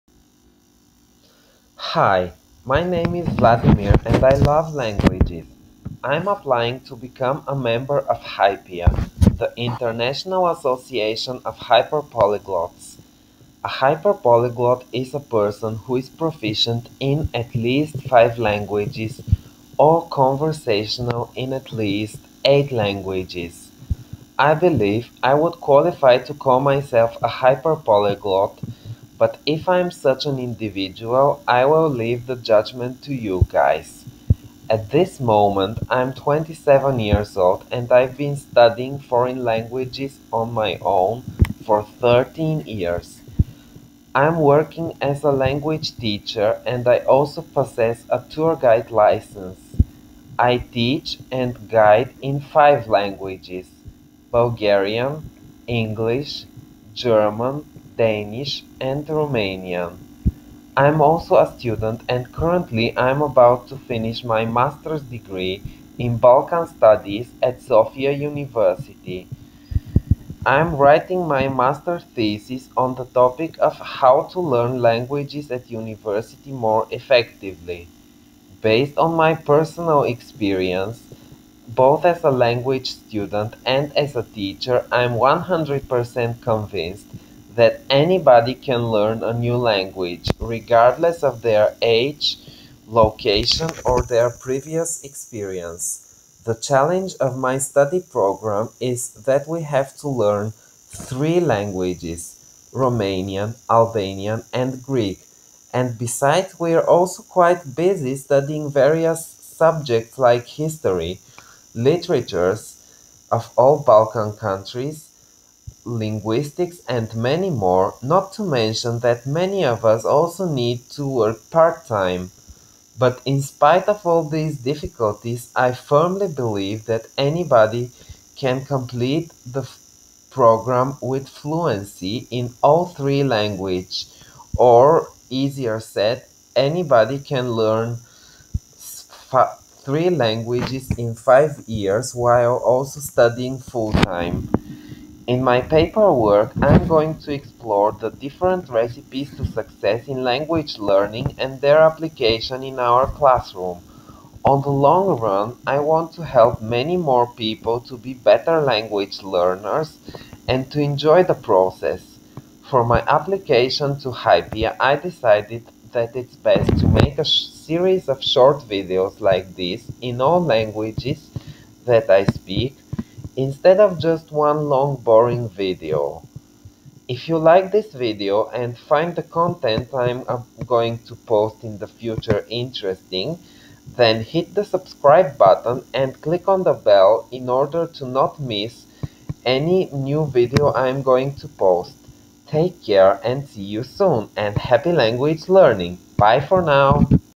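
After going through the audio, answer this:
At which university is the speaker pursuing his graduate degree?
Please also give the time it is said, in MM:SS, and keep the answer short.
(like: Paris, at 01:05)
Sofia University, at 01:07.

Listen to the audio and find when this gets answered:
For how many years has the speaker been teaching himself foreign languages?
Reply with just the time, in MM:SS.
00:41.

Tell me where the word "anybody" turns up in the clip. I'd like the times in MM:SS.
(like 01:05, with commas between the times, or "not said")
01:27, 02:07, 02:16.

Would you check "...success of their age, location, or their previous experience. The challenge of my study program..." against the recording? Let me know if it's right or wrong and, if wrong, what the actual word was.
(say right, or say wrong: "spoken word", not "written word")
wrong: "regardless", not "success".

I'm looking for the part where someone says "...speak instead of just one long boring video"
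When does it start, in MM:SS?
02:52.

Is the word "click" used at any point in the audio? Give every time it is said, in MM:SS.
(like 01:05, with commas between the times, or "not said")
03:06.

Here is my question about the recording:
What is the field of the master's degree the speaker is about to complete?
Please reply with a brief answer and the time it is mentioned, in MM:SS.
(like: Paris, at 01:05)
Balkan Studies, at 01:06.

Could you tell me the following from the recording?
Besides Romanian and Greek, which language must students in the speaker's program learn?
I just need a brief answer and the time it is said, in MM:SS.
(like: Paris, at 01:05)
Albanian, at 01:43.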